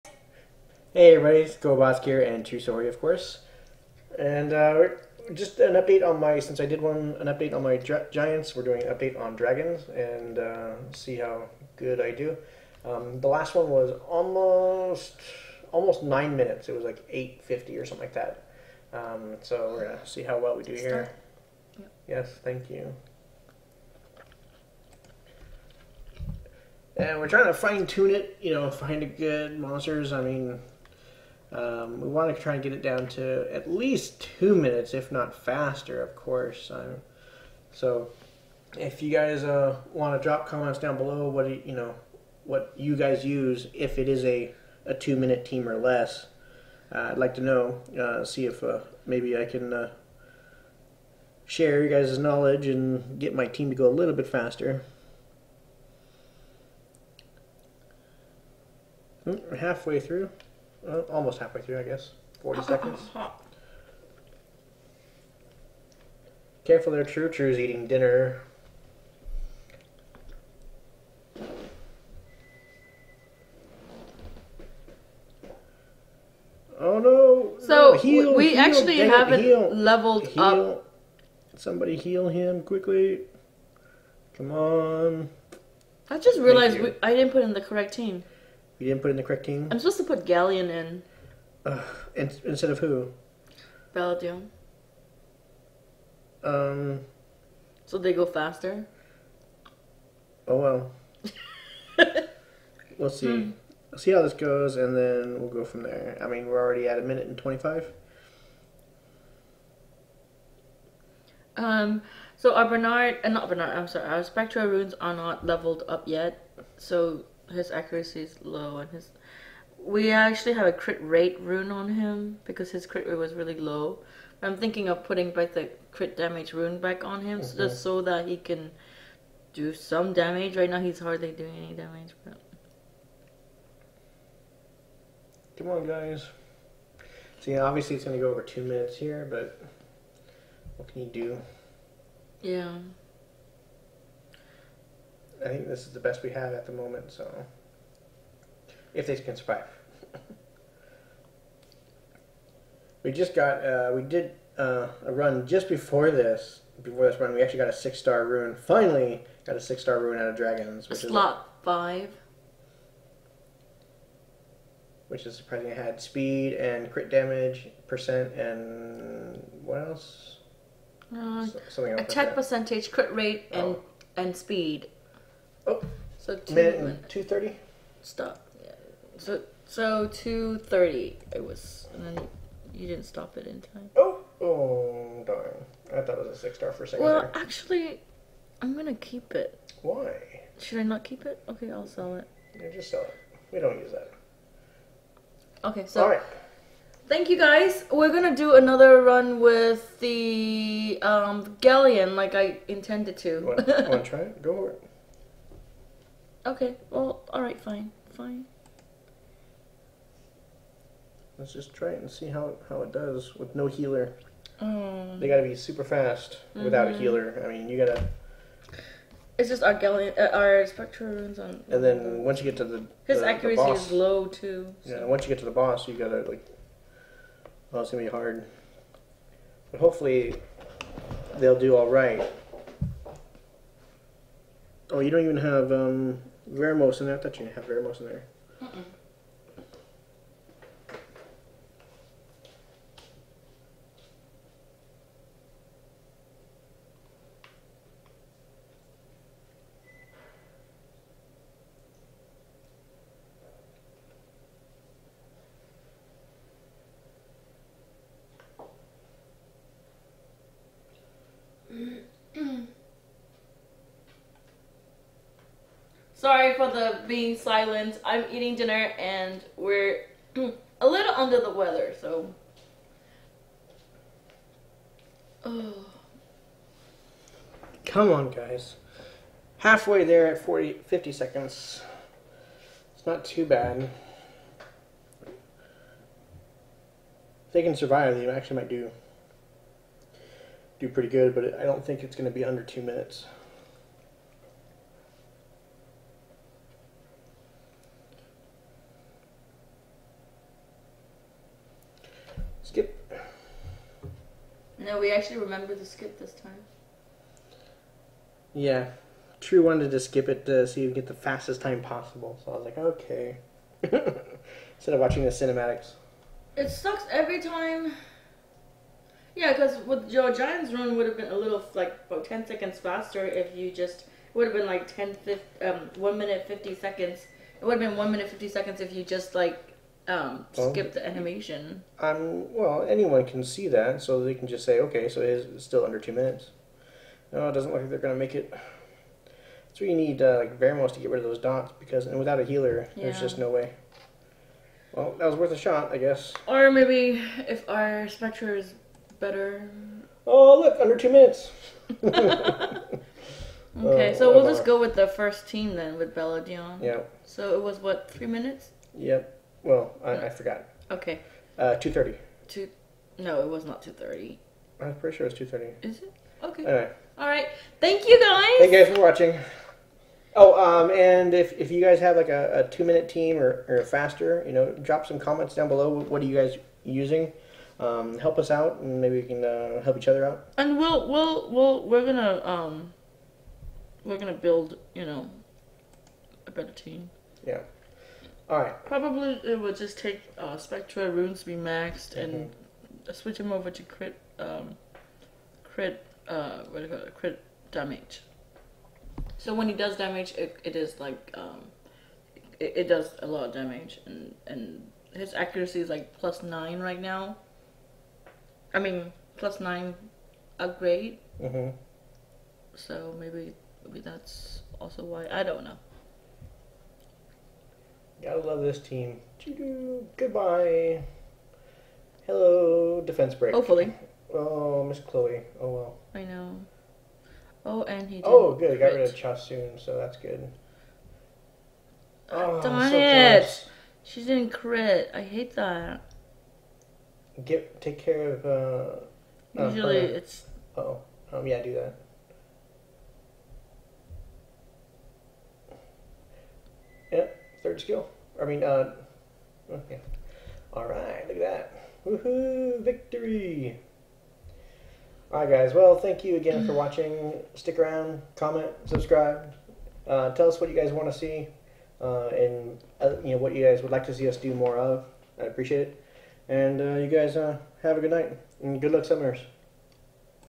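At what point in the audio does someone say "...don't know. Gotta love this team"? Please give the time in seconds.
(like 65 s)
415 s.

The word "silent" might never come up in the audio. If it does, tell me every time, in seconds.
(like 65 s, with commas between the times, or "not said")
267 s.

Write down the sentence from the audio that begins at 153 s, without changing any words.
we just got, uh, we did uh, a run just before this, before this run, we actually got a six-star rune.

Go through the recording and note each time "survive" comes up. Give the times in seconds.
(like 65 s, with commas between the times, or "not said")
149 s, 287 s.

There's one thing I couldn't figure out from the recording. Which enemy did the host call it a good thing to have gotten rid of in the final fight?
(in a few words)
Chasun.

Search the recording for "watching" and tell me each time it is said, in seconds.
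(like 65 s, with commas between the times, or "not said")
314 s, 369 s, 456 s.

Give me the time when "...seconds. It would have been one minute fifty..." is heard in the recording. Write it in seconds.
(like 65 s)
326 s.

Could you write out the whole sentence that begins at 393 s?
switch him over to crit, um, crit, uh, what do you call it?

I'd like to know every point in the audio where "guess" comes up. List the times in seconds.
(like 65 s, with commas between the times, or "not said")
61 s, 345 s.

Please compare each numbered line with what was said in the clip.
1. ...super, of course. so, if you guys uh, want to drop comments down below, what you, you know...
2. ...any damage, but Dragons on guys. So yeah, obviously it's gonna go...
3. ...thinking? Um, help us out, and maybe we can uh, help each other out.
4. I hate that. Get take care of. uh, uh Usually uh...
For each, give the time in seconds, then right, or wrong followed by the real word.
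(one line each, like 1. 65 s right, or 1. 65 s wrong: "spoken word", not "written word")
1. 35 s wrong: "faster", not "super"
2. 131 s wrong: "Come", not "Dragons"
3. 376 s wrong: "using", not "thinking"
4. 435 s right.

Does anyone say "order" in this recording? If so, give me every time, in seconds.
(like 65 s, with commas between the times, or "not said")
not said.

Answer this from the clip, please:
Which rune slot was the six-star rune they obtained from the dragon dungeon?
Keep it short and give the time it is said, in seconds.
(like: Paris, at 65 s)
5, at 161 s.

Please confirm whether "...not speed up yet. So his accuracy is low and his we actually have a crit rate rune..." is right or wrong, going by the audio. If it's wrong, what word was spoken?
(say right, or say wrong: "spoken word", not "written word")
wrong: "leveled", not "speed".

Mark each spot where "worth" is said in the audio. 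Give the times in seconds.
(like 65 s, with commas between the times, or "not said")
345 s.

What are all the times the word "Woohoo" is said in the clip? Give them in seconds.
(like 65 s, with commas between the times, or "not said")
452 s.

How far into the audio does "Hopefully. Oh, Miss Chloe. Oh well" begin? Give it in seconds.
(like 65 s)
423 s.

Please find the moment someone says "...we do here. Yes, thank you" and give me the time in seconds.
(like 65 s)
20 s.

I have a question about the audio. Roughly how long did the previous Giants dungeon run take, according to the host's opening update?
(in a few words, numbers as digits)
8.50.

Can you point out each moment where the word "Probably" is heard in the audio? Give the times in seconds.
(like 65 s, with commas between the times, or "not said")
388 s.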